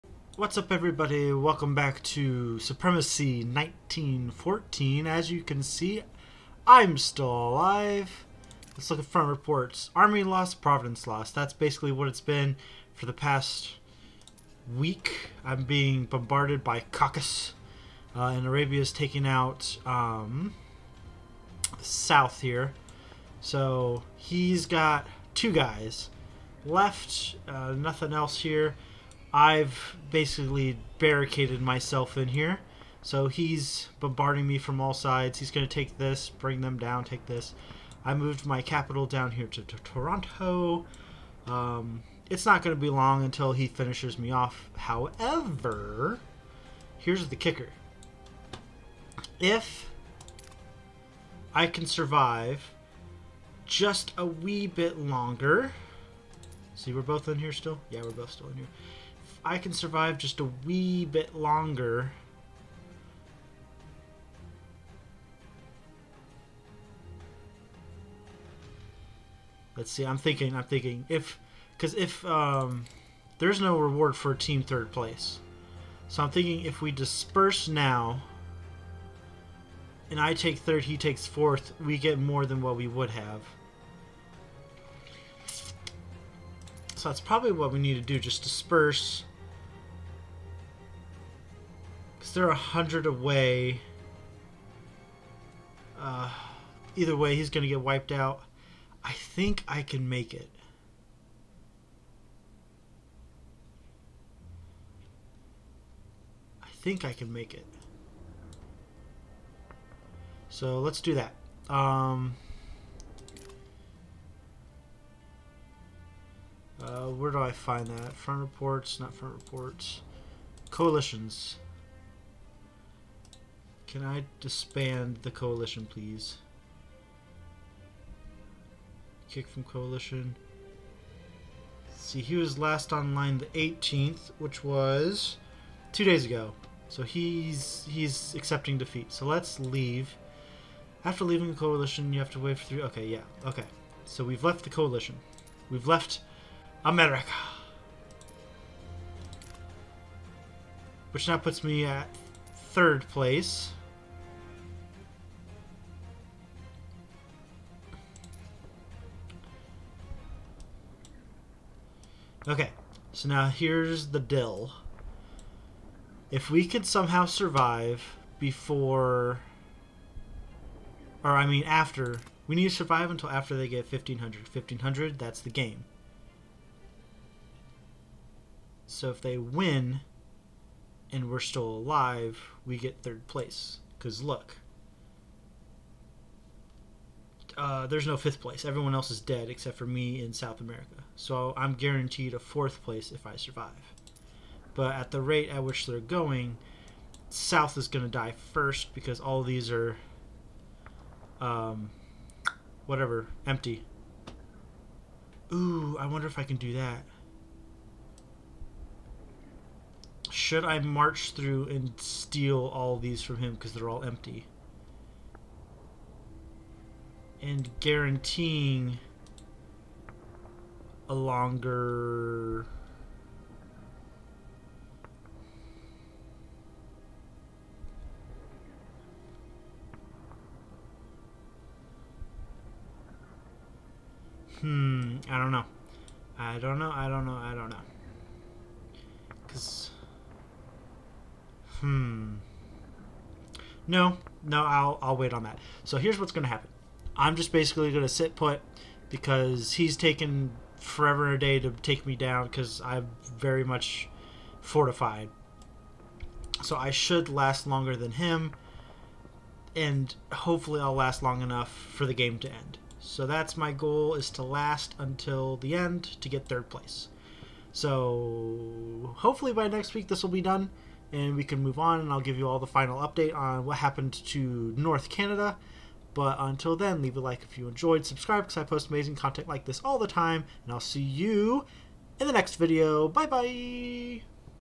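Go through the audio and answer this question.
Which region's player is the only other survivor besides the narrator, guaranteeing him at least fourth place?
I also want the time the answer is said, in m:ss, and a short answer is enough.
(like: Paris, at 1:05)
South America, at 3:10.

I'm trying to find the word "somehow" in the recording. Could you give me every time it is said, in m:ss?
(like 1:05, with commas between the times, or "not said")
2:46.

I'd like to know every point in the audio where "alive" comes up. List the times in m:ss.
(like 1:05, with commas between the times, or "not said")
0:07, 3:01.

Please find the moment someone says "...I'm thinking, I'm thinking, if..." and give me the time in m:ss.
1:10.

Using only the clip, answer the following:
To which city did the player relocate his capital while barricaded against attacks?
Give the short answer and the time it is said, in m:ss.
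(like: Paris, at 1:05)
Toronto, at 0:39.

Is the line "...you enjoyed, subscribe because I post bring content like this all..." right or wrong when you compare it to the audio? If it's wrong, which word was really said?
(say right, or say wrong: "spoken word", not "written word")
wrong: "amazing", not "bring".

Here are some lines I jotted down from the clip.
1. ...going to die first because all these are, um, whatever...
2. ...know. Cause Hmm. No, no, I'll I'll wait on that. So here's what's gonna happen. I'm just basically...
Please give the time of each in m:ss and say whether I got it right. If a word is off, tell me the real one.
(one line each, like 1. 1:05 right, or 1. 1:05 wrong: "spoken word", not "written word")
1. 3:17 right
2. 3:57 right.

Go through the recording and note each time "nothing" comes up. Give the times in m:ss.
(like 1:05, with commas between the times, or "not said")
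0:27.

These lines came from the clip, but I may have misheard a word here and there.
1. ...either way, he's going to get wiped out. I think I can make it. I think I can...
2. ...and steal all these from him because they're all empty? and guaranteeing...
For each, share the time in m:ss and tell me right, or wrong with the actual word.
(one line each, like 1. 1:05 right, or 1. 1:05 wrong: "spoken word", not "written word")
1. 1:36 right
2. 3:31 right.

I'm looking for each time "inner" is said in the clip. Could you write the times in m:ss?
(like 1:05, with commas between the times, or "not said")
not said.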